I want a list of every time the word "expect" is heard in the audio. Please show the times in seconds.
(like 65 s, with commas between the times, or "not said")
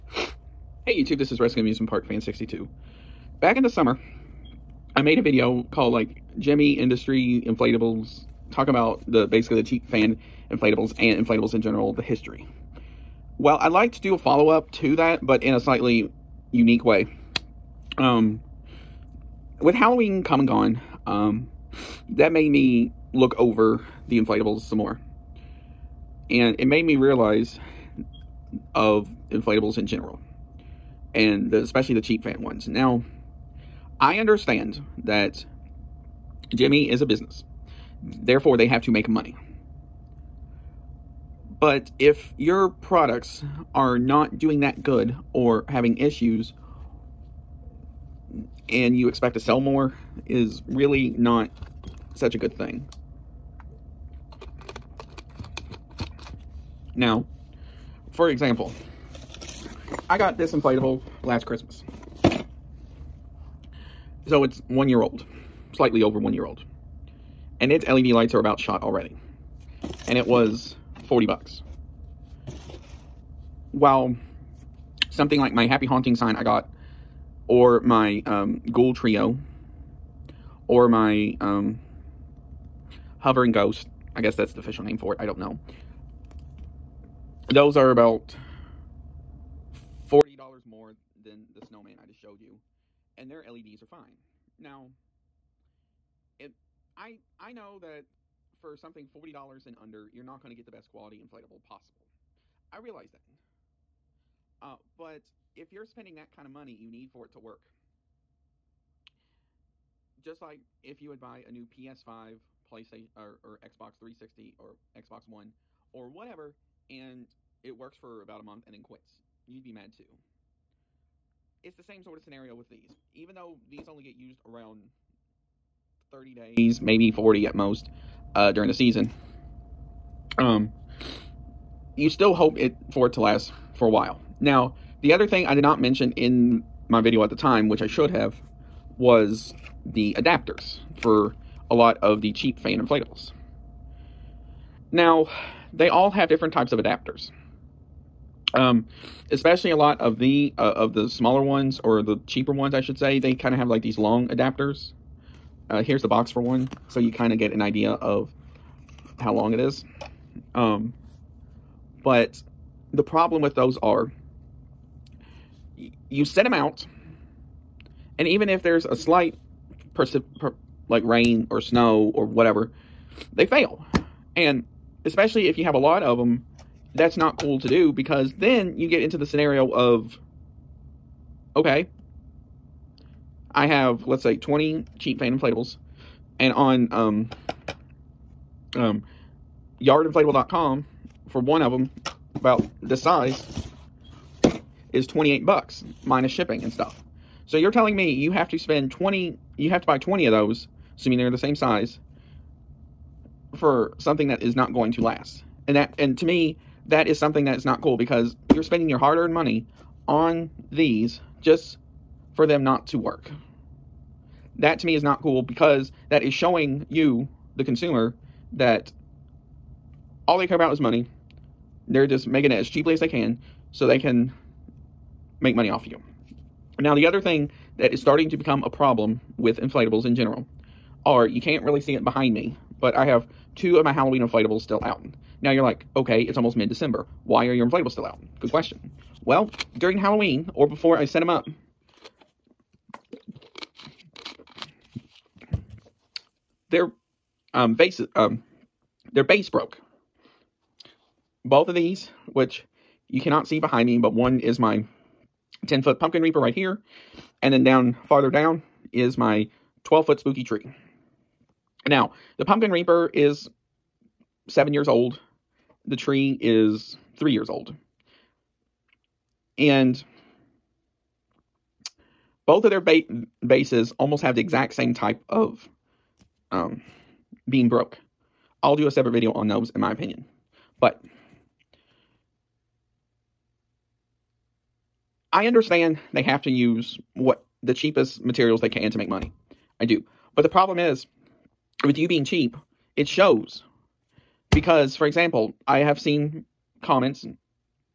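49 s.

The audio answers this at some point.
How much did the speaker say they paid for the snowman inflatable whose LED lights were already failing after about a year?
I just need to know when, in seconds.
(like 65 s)
71 s.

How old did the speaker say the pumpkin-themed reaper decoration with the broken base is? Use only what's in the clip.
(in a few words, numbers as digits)
7 years.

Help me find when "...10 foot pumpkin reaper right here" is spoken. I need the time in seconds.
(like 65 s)
255 s.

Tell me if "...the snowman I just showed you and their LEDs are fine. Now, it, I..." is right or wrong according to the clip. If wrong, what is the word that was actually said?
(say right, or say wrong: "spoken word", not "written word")
right.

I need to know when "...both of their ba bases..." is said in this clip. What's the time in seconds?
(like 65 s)
272 s.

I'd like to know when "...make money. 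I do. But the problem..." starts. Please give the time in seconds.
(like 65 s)
288 s.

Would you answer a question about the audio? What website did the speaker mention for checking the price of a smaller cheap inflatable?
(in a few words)
yardinflatable.com.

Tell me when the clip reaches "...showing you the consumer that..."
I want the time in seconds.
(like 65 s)
216 s.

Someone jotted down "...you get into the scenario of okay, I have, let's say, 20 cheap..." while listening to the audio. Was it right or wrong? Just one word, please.
right.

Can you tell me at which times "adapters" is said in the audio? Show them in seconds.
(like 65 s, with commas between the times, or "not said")
140 s, 146 s, 154 s.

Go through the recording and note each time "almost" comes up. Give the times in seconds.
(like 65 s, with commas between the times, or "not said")
236 s, 273 s.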